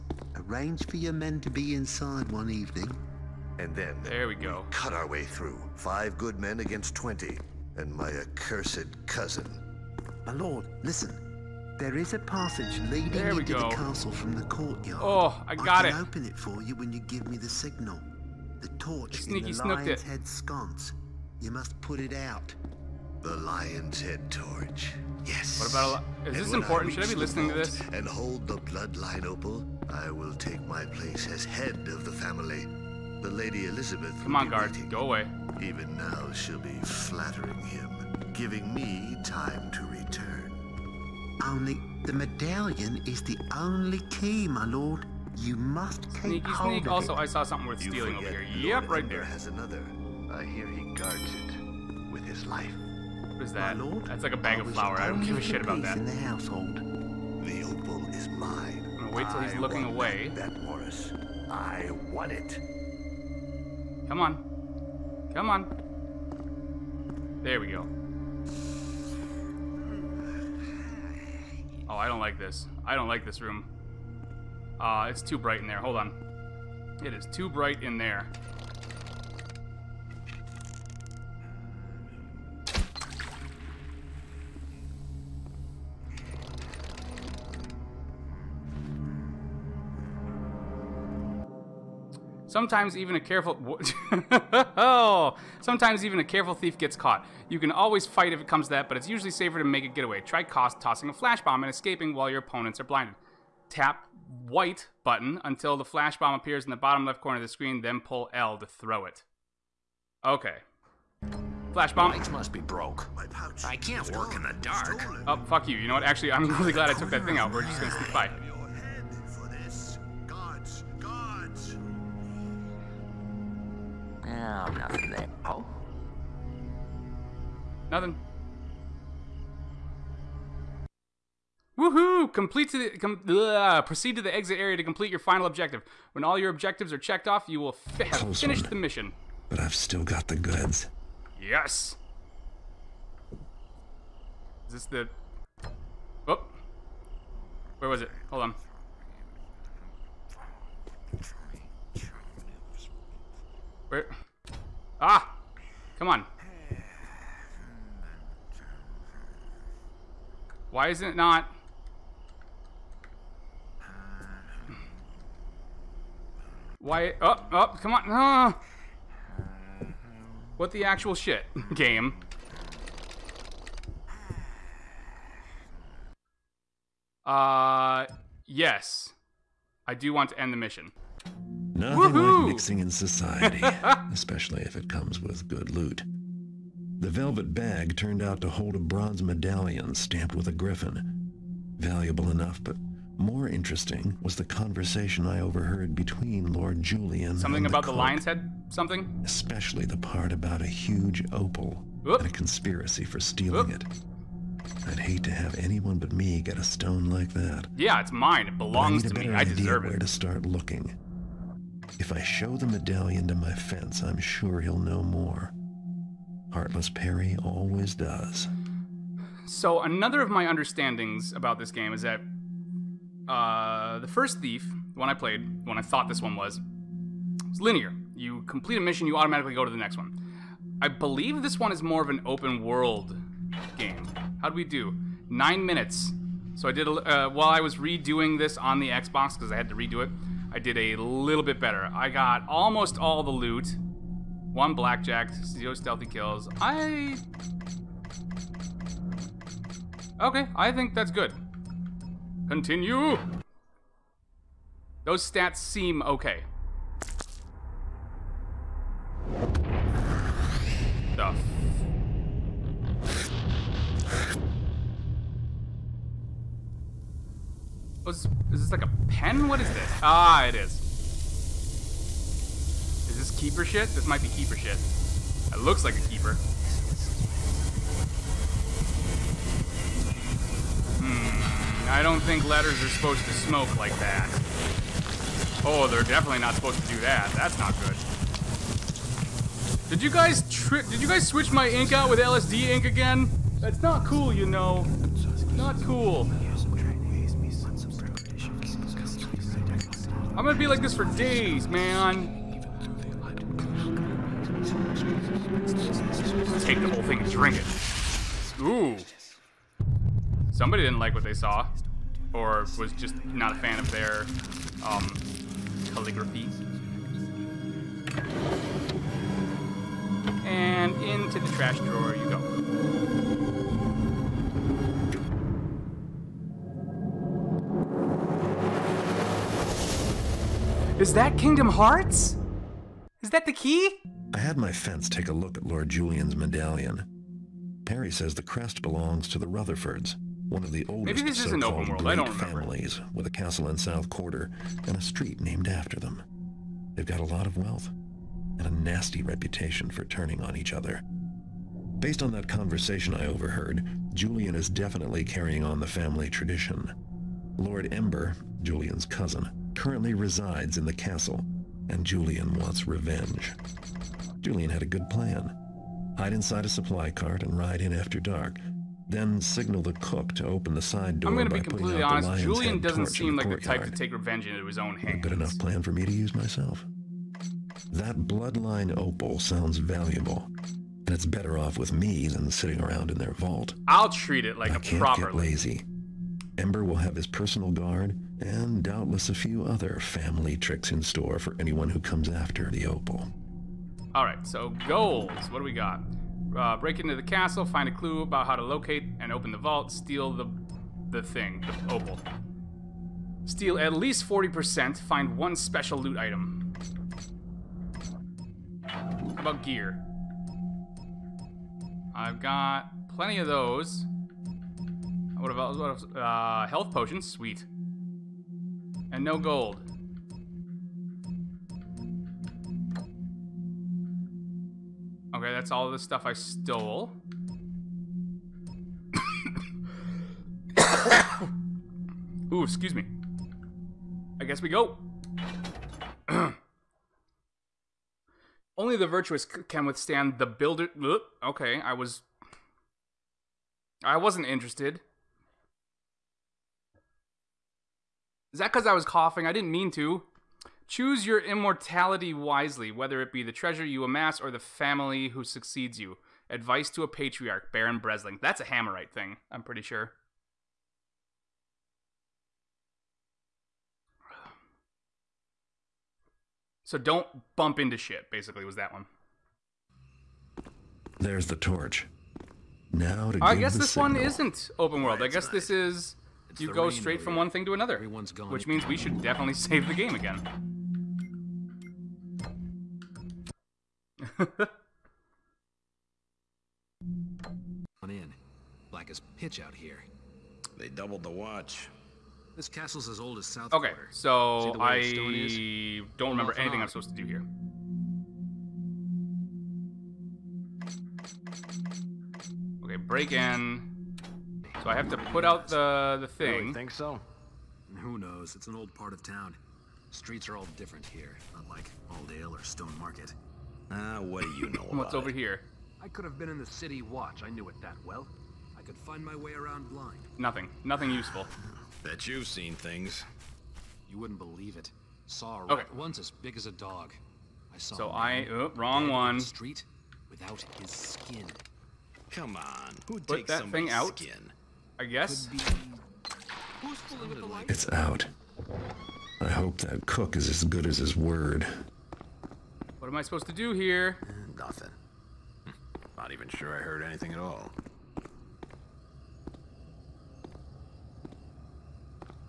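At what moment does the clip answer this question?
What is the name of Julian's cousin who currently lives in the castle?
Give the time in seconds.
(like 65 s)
357 s.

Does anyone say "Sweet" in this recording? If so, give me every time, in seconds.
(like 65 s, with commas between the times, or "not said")
417 s.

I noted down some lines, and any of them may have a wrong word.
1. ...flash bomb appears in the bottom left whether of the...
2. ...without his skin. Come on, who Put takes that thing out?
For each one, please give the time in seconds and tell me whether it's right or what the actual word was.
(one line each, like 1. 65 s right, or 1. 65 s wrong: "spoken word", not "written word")
1. 105 s wrong: "corner", not "whether"
2. 530 s right.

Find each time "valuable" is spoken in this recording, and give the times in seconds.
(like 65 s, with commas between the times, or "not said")
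191 s, 379 s.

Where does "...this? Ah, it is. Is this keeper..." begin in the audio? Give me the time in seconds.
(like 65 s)
269 s.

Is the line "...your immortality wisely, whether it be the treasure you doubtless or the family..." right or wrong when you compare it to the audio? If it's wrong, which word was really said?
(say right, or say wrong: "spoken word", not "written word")
wrong: "amass", not "doubtless".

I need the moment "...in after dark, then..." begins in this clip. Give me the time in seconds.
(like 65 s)
367 s.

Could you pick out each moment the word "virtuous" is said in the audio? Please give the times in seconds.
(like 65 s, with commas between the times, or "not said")
439 s.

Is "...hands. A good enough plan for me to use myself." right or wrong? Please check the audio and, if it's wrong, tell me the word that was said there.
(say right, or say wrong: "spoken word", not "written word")
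right.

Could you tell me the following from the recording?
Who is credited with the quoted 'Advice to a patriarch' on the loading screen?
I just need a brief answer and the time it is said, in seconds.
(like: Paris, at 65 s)
Baron Bresling, at 457 s.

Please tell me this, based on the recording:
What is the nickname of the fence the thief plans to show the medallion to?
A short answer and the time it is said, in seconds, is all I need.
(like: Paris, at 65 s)
Heartless Perry, at 216 s.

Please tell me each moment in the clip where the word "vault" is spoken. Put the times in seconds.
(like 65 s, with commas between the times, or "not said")
383 s, 399 s.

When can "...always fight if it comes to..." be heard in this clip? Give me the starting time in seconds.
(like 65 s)
97 s.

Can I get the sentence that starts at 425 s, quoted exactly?
Okay, that's all the stuff I stole.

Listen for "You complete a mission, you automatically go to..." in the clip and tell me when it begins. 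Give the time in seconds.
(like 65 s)
228 s.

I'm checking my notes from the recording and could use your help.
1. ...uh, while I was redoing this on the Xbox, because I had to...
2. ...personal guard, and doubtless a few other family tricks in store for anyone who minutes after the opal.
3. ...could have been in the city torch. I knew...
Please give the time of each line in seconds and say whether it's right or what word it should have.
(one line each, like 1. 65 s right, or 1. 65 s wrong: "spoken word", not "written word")
1. 236 s right
2. 387 s wrong: "comes", not "minutes"
3. 516 s wrong: "watch", not "torch".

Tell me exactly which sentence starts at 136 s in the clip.
When all your objectives are checked off, you will fi have finished the mission.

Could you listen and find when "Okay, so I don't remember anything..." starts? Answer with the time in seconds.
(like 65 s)
493 s.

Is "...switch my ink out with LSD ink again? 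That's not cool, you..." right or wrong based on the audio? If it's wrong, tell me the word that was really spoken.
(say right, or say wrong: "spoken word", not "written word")
right.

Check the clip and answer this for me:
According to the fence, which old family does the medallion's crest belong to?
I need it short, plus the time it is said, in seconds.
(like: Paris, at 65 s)
The Rutherfords, at 339 s.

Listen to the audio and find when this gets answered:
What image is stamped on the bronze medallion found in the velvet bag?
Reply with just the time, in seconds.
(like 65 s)
190 s.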